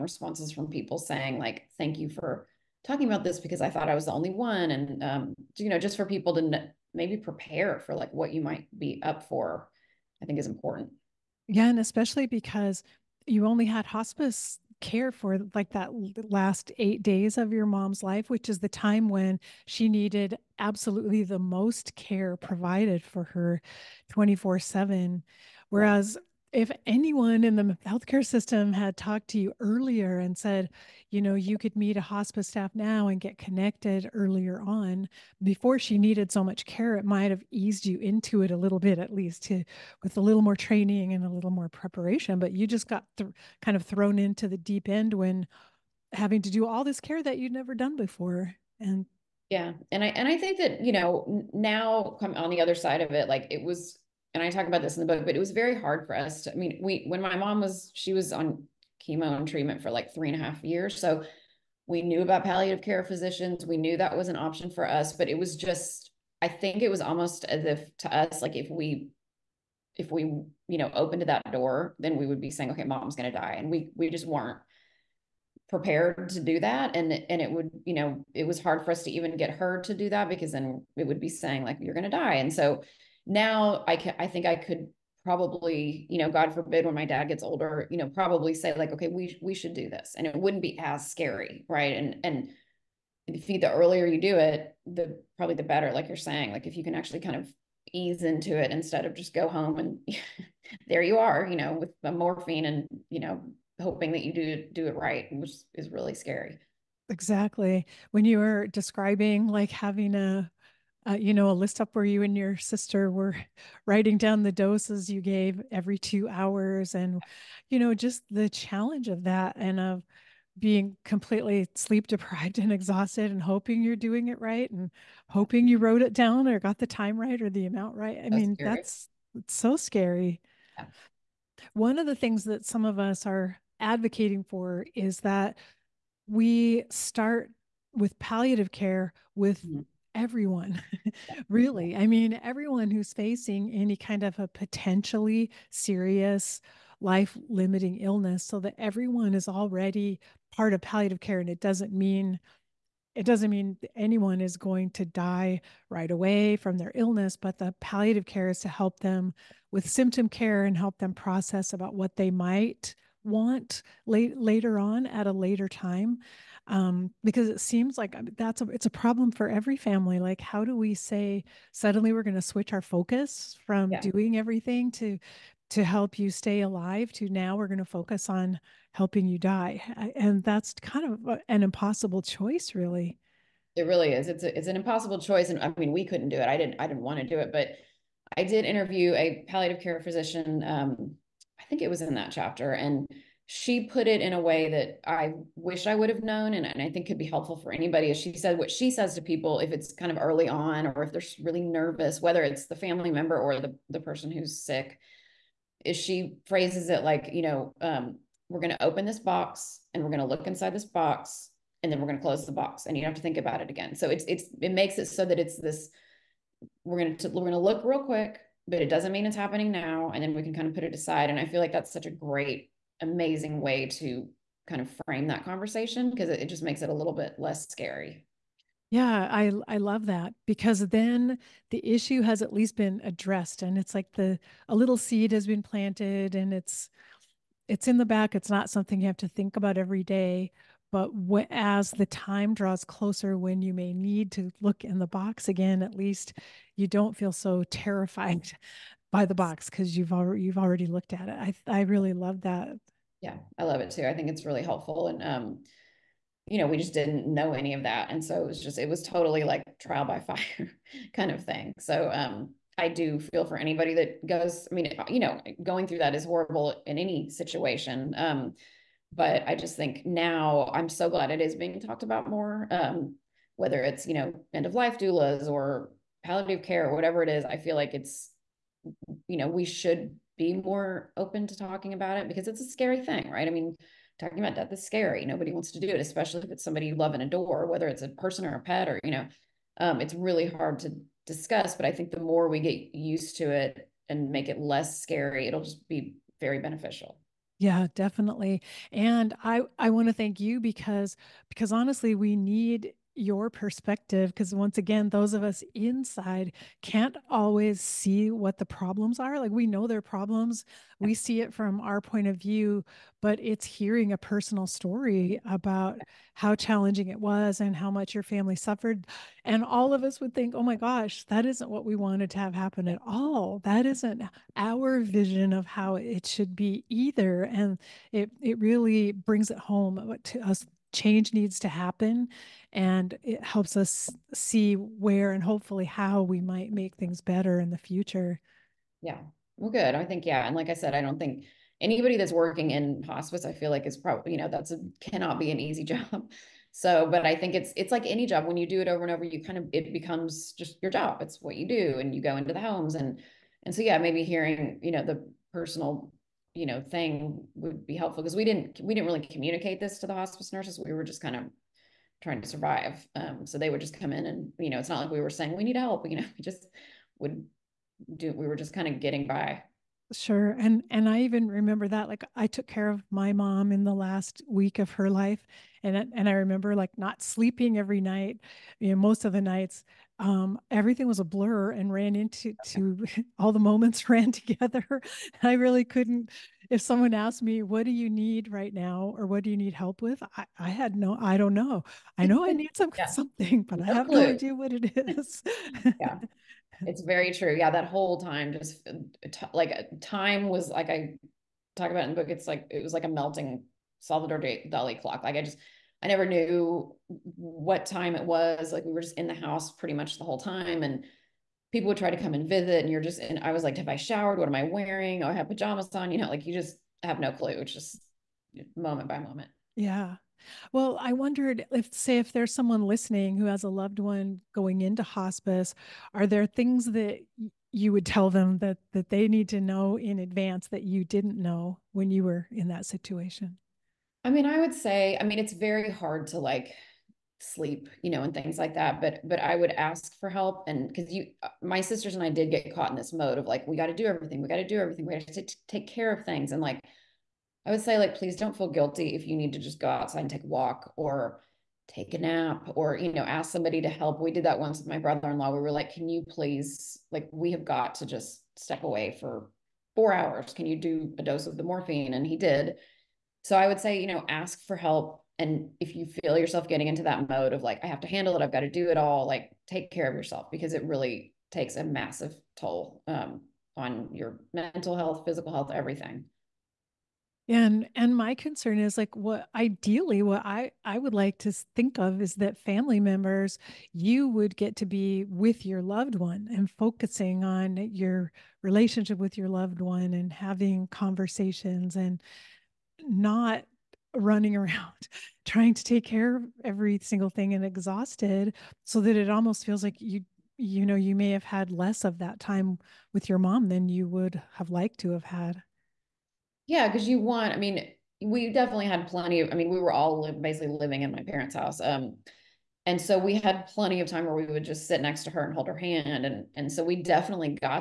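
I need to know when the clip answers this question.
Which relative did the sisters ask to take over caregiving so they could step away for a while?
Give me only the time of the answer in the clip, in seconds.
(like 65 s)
454 s.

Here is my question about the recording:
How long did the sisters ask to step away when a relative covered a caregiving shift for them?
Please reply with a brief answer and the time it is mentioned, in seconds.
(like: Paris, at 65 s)
4 hours, at 459 s.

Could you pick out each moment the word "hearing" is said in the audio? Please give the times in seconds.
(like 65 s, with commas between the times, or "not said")
313 s, 354 s.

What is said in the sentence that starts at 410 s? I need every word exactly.
And people would try to come and visit.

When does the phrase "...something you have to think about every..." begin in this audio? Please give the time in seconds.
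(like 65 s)
238 s.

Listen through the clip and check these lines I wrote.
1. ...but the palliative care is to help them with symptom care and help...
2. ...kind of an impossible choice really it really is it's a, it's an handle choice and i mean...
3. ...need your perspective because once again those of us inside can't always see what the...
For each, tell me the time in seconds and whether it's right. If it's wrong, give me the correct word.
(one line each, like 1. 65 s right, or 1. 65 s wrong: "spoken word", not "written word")
1. 157 s right
2. 180 s wrong: "impossible", not "handle"
3. 302 s right.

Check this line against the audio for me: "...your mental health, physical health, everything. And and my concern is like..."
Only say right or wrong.
right.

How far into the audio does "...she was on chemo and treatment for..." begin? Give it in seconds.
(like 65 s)
57 s.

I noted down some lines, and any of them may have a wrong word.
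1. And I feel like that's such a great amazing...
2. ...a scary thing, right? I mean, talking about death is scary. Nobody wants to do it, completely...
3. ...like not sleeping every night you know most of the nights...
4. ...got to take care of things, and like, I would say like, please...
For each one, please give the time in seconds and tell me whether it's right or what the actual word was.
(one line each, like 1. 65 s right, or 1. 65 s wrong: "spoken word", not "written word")
1. 221 s right
2. 282 s wrong: "especially", not "completely"
3. 376 s right
4. 445 s right.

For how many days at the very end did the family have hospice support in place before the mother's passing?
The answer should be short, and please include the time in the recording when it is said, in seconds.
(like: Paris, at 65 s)
8, at 16 s.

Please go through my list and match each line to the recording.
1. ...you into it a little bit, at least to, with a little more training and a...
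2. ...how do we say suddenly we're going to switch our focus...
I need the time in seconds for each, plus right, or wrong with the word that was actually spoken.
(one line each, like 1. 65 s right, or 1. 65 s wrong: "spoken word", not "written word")
1. 37 s right
2. 170 s right.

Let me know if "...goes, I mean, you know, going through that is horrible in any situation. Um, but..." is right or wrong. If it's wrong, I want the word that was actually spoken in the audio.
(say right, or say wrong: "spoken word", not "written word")
right.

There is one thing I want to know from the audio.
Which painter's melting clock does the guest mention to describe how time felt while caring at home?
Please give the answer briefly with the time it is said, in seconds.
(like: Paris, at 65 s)
Salvador Dali, at 403 s.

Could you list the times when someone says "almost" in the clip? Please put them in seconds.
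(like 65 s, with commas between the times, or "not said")
67 s, 499 s.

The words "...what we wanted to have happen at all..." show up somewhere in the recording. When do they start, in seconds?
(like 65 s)
321 s.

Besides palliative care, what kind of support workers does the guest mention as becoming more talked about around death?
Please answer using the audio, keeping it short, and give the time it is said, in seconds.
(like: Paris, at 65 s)
End of life doulas, at 274 s.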